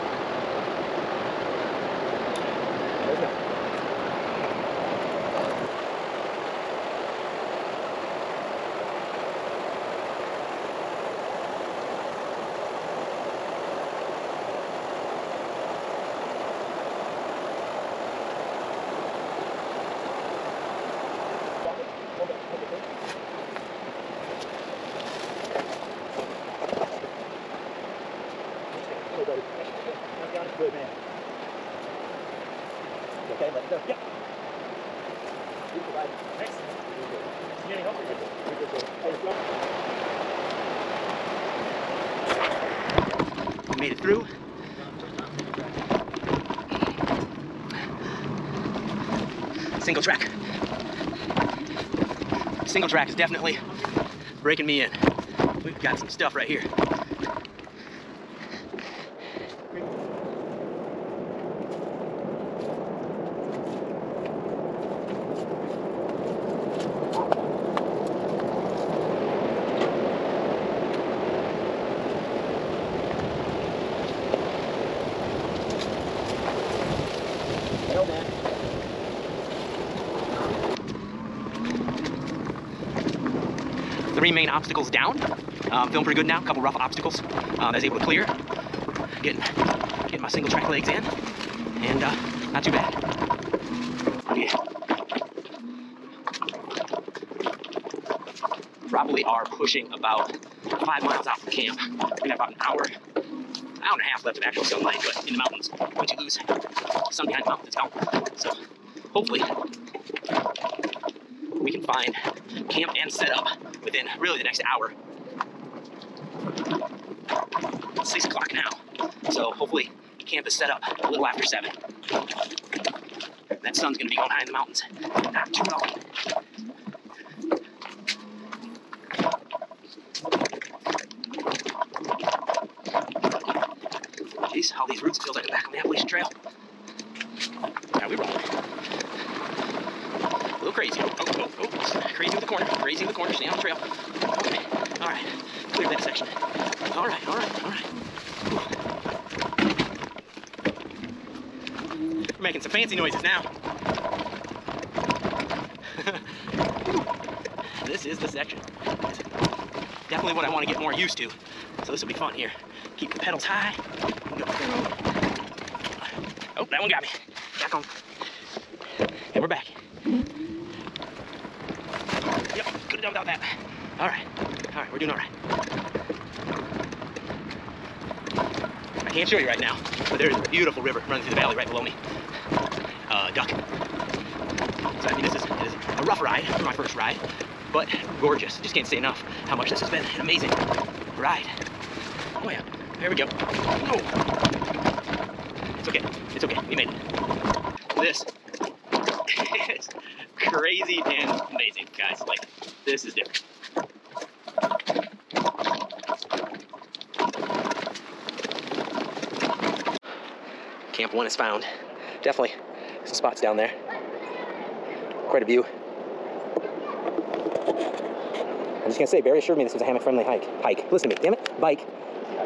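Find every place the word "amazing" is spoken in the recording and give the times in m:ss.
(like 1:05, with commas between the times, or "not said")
3:10, 3:21.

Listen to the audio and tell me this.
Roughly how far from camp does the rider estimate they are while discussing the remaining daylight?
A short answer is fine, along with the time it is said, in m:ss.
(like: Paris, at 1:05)
5 miles, at 1:39.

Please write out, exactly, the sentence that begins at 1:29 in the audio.
Getting, getting my single track legs in and uh, not too bad.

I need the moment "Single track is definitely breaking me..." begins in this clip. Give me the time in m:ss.
0:52.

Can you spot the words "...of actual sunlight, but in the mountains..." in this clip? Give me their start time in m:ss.
1:44.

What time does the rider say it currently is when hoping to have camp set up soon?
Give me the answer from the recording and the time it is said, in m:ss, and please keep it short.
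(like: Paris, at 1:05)
6:00, at 1:58.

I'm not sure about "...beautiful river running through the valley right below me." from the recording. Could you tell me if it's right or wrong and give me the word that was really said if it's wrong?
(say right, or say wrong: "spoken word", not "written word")
right.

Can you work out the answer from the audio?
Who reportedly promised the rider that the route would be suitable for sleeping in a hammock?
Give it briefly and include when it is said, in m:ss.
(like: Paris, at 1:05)
Barry, at 3:39.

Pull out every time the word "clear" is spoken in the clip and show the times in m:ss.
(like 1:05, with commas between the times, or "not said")
1:28, 2:25.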